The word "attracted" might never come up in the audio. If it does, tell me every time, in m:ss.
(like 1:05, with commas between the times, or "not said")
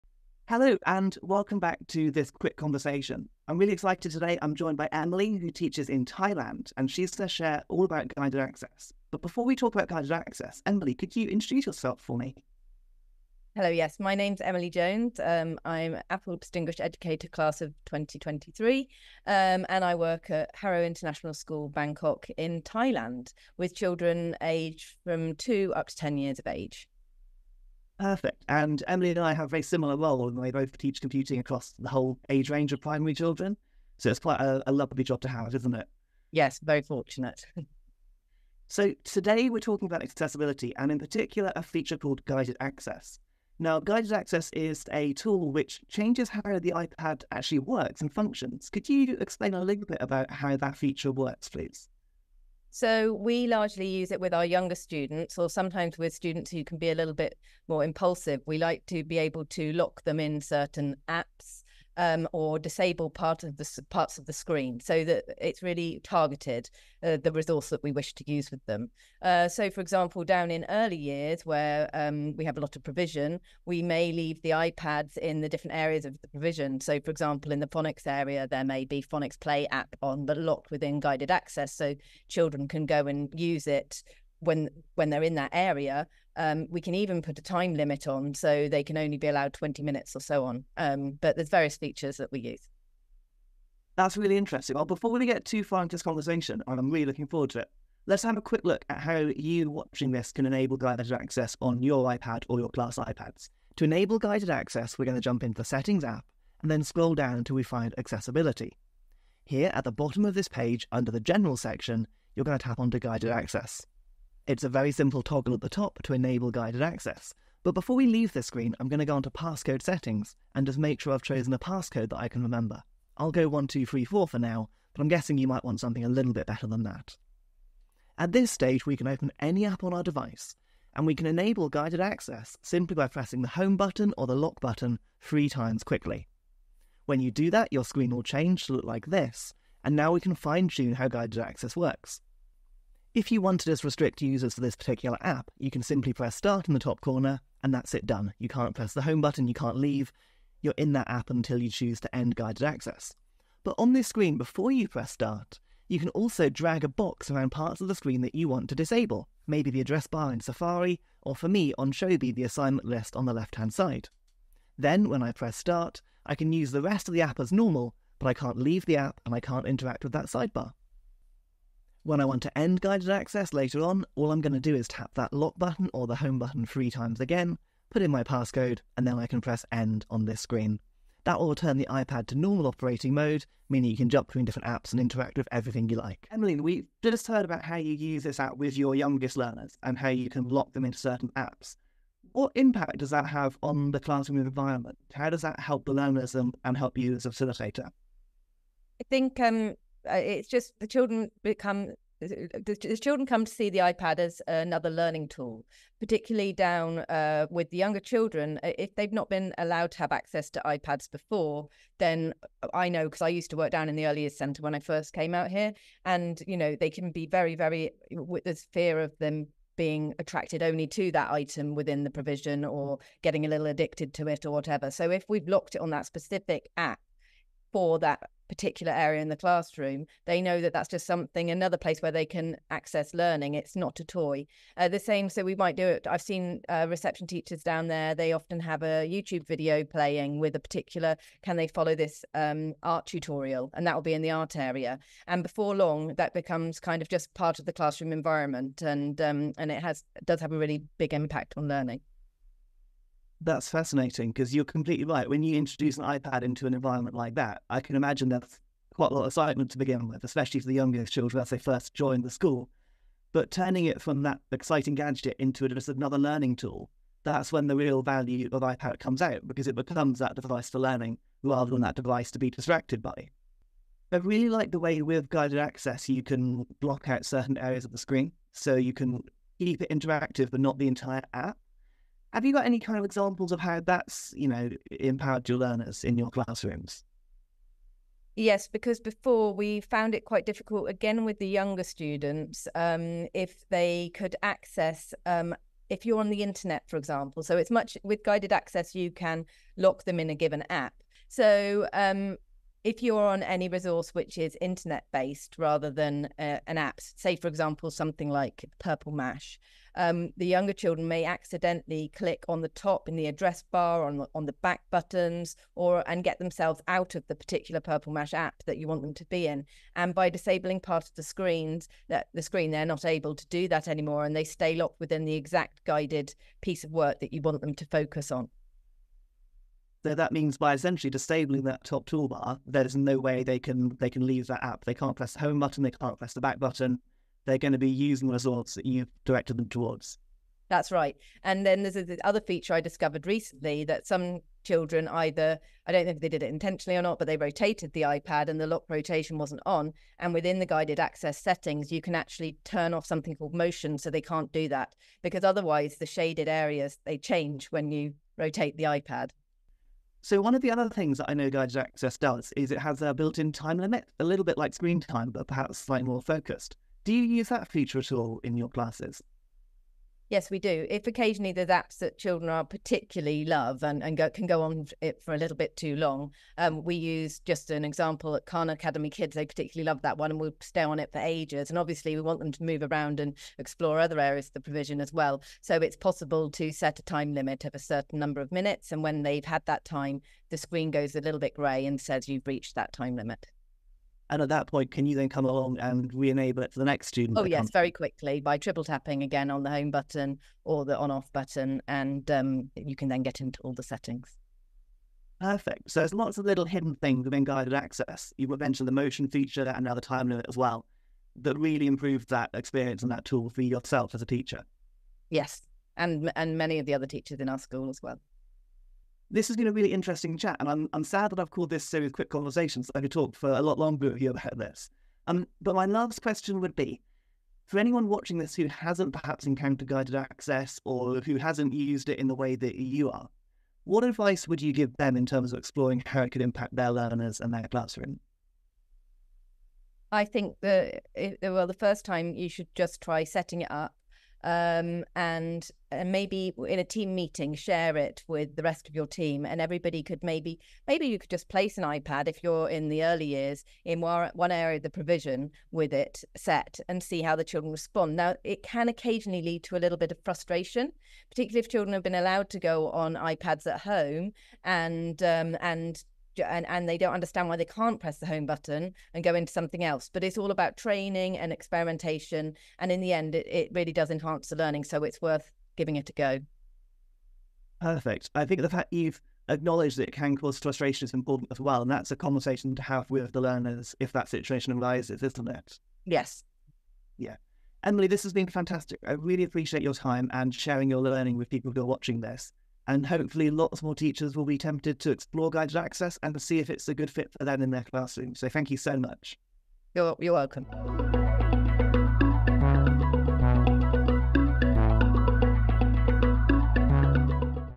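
3:40.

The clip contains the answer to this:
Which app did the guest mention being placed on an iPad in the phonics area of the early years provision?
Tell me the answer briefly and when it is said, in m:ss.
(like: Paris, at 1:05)
Phonics Play, at 1:19.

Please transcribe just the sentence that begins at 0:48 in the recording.
Could you explain a little bit about how that feature works, please?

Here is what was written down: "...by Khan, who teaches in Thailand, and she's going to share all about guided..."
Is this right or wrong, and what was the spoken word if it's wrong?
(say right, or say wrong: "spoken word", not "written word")
wrong: "Emily", not "Khan".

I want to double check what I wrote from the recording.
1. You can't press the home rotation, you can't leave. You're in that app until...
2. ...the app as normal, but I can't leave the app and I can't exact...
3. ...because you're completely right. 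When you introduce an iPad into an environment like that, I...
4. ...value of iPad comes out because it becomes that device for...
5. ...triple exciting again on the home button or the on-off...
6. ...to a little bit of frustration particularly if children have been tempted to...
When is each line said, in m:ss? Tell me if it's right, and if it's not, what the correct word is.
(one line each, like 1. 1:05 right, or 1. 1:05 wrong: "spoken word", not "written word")
1. 2:28 wrong: "button", not "rotation"
2. 2:47 wrong: "interact", not "exact"
3. 4:14 right
4. 4:28 right
5. 6:38 wrong: "tapping", not "exciting"
6. 7:39 wrong: "allowed", not "tempted".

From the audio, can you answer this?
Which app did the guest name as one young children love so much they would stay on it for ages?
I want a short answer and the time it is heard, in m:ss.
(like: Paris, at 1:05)
Khan Academy Kids, at 6:18.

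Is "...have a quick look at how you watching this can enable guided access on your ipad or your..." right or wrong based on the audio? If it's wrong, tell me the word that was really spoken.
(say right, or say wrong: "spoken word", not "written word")
right.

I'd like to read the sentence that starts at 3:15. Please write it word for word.
How does that help the learners and, and help you as a facilitator?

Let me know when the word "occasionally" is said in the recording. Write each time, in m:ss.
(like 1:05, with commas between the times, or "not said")
6:11, 7:38.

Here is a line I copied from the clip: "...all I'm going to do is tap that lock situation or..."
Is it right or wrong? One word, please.
wrong.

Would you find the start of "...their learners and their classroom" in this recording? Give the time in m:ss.
7:16.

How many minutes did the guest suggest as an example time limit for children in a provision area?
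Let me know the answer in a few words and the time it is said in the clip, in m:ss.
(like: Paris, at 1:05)
20, at 1:29.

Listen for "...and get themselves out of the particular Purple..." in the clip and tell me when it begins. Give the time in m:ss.
5:16.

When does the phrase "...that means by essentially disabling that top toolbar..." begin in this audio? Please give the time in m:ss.
5:30.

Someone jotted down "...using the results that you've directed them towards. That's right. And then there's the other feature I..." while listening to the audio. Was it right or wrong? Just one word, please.
right.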